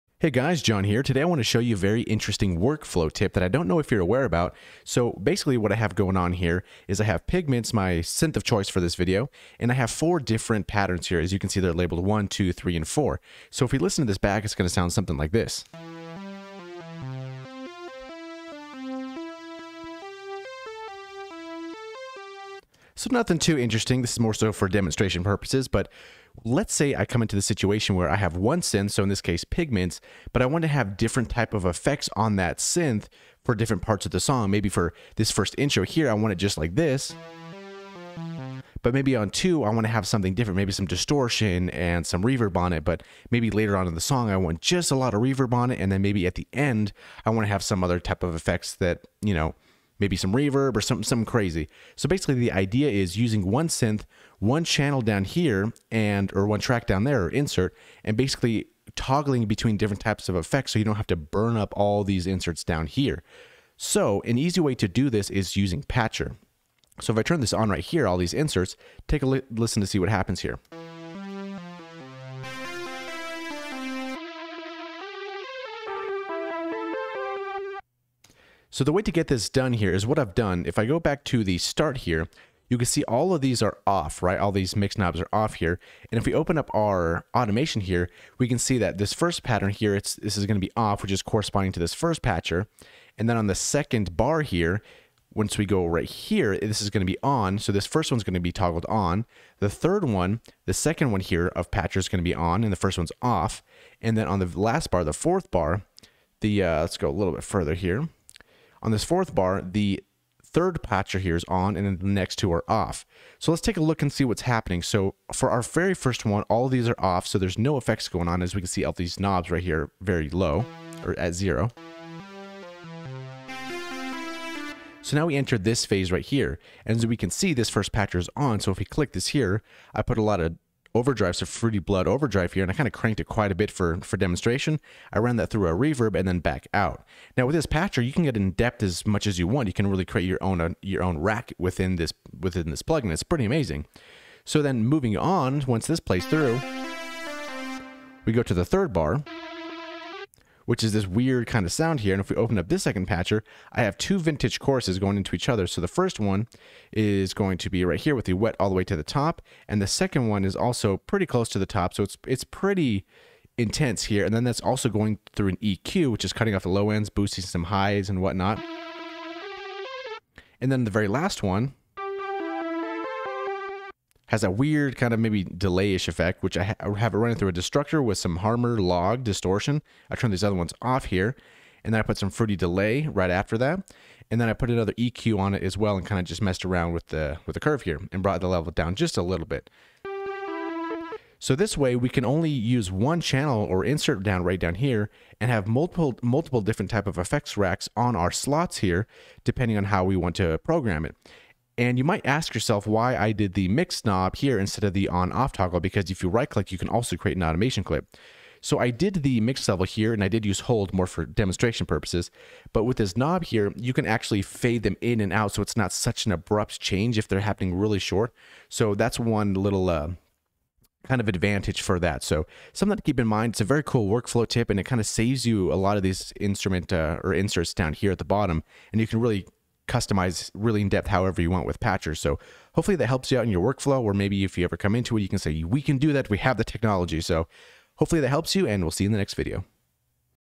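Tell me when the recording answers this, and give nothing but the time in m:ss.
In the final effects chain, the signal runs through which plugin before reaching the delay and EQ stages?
2:57.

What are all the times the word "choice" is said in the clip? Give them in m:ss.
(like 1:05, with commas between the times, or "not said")
0:08.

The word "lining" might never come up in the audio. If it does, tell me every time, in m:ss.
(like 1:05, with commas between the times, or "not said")
not said.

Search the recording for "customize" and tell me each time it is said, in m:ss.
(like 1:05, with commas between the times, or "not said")
3:49.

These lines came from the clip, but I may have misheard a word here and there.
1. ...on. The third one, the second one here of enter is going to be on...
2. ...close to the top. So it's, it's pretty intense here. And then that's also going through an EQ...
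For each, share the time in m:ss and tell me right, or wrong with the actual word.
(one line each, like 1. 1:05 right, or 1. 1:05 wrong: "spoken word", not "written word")
1. 1:38 wrong: "patcher", not "enter"
2. 2:41 right.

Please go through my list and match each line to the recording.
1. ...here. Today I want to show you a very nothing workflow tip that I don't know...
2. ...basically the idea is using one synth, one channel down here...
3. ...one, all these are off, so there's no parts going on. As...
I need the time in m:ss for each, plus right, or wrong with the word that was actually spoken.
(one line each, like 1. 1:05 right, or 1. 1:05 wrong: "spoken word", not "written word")
1. 0:00 wrong: "interesting", not "nothing"
2. 0:52 right
3. 1:56 wrong: "effects", not "parts".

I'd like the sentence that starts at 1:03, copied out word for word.
So an easy way to do this is using Patcher.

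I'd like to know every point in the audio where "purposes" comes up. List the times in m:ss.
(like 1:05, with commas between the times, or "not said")
0:25, 3:31.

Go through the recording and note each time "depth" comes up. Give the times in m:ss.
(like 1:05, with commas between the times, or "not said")
2:18, 3:50.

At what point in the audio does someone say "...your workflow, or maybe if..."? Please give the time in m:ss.
3:53.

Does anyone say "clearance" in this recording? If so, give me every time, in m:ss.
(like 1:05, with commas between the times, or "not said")
not said.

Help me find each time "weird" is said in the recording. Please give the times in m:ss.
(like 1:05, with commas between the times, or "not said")
2:31, 2:54.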